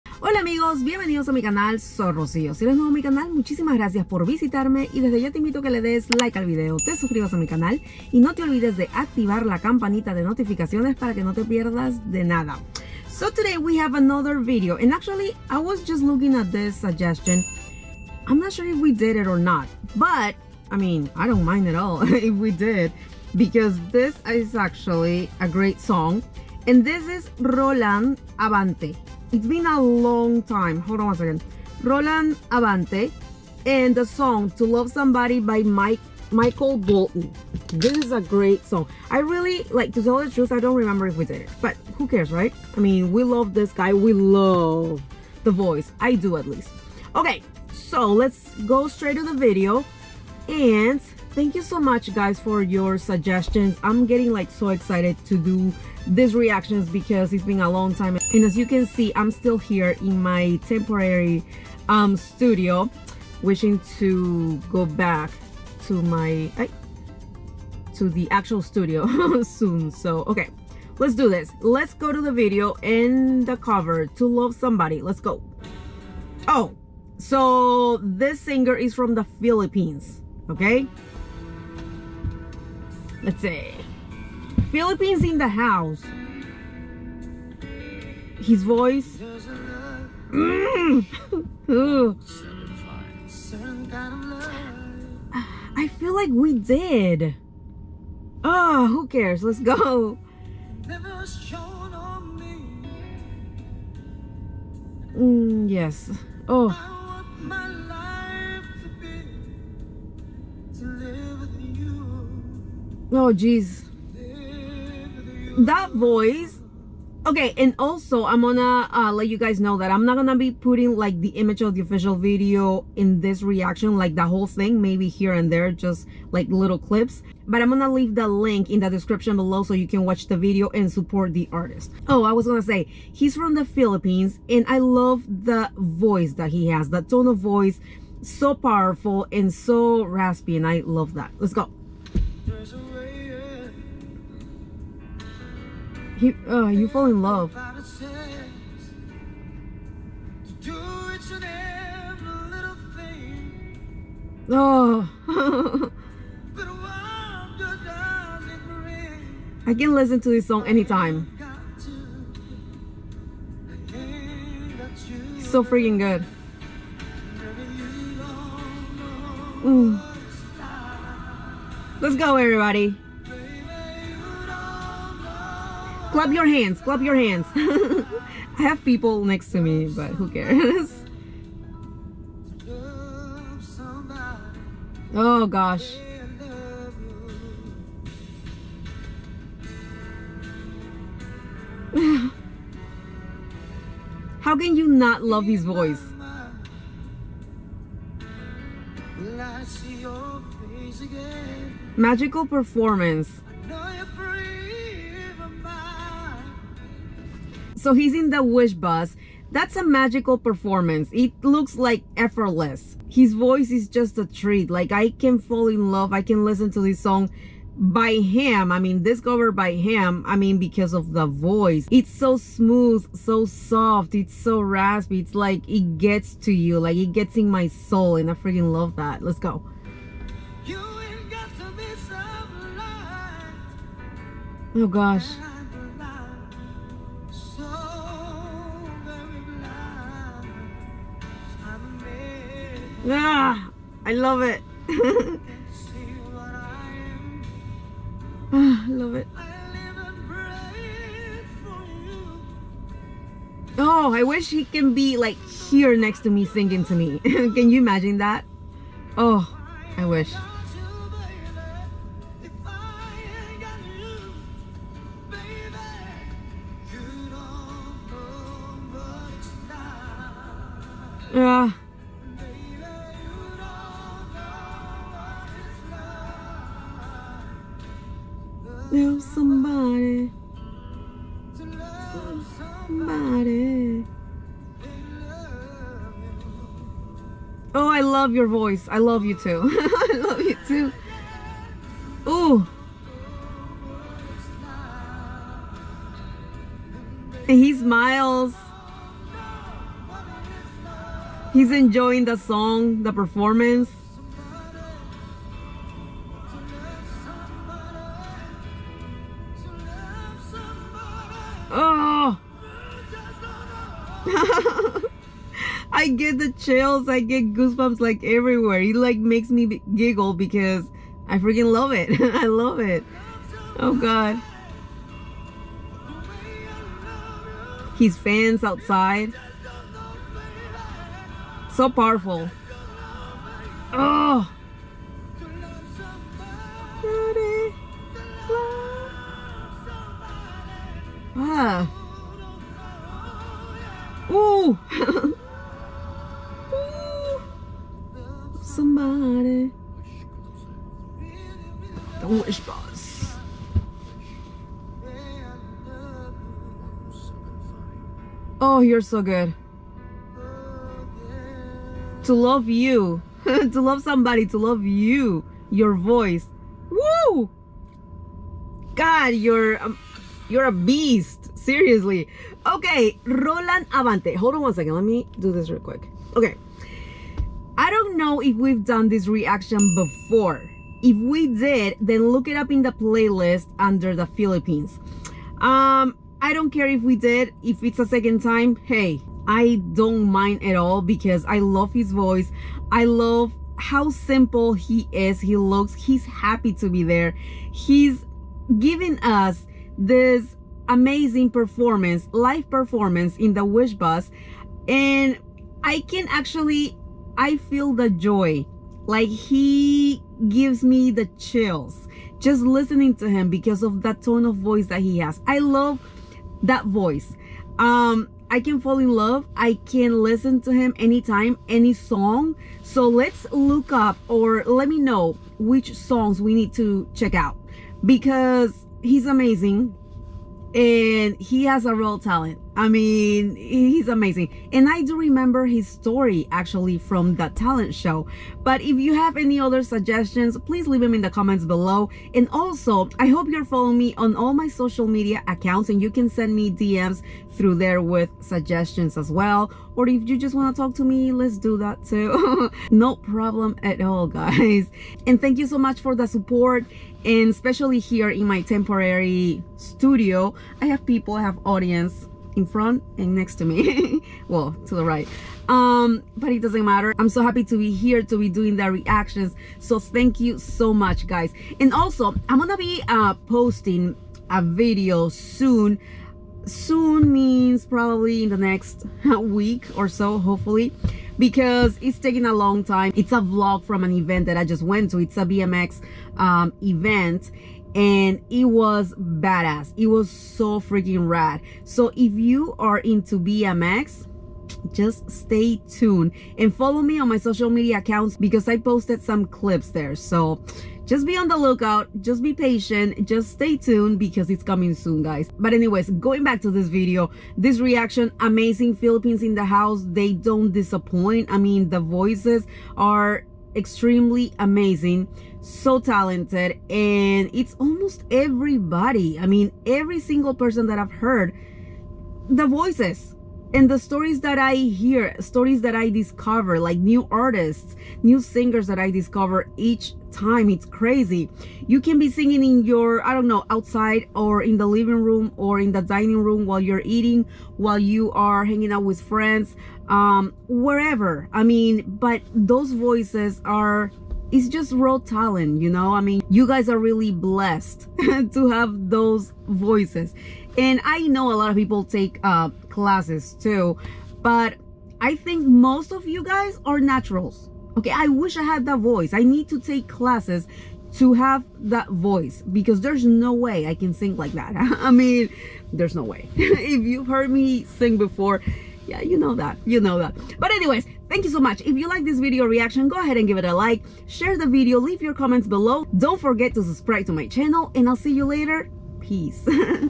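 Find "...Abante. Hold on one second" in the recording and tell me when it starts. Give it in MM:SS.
06:13.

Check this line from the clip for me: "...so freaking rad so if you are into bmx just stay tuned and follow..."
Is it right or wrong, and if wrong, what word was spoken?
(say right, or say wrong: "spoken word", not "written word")
right.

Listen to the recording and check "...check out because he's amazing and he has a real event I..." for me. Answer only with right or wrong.
wrong.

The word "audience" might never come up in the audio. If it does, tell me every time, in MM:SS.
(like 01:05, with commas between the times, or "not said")
07:41.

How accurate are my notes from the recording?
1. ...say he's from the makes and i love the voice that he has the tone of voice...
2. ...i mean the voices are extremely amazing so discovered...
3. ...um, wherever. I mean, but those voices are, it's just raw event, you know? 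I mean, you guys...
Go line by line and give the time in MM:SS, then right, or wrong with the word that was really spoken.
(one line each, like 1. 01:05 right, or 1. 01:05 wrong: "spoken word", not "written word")
1. 02:12 wrong: "philippines", not "makes"
2. 08:31 wrong: "talented", not "discovered"
3. 09:00 wrong: "talent", not "event".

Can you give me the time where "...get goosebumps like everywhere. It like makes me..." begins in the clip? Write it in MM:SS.
05:17.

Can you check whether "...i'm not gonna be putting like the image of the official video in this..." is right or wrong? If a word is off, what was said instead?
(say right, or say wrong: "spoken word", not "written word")
right.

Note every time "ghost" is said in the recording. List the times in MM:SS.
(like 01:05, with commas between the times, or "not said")
not said.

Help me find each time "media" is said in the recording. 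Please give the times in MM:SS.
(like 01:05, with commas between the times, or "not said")
07:25, 08:17.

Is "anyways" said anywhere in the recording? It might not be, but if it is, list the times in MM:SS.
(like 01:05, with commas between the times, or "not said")
08:25, 09:30.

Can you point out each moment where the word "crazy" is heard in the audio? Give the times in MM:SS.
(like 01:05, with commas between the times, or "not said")
08:50.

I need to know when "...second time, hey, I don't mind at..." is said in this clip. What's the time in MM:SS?
06:28.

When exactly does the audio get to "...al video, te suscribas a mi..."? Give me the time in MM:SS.
00:06.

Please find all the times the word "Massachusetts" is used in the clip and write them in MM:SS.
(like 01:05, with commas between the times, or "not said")
not said.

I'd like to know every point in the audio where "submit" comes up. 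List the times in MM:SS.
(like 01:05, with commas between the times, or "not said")
not said.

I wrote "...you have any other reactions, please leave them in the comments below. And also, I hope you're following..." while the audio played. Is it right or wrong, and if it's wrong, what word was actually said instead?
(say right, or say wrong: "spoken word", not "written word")
wrong: "suggestions", not "reactions".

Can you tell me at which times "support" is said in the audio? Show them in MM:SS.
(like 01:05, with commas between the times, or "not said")
02:10, 07:36.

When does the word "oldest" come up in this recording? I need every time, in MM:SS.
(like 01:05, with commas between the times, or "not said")
not said.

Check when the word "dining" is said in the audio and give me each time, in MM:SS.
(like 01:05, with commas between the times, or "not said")
08:56.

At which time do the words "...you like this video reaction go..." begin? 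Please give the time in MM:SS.
09:31.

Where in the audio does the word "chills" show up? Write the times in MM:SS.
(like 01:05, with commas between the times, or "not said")
05:16, 06:51.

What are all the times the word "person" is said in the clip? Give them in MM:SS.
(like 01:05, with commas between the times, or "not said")
08:40.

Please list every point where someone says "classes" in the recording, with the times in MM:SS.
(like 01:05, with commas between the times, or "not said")
09:12, 09:20.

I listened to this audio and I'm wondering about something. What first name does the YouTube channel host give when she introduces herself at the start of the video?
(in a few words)
Rocío.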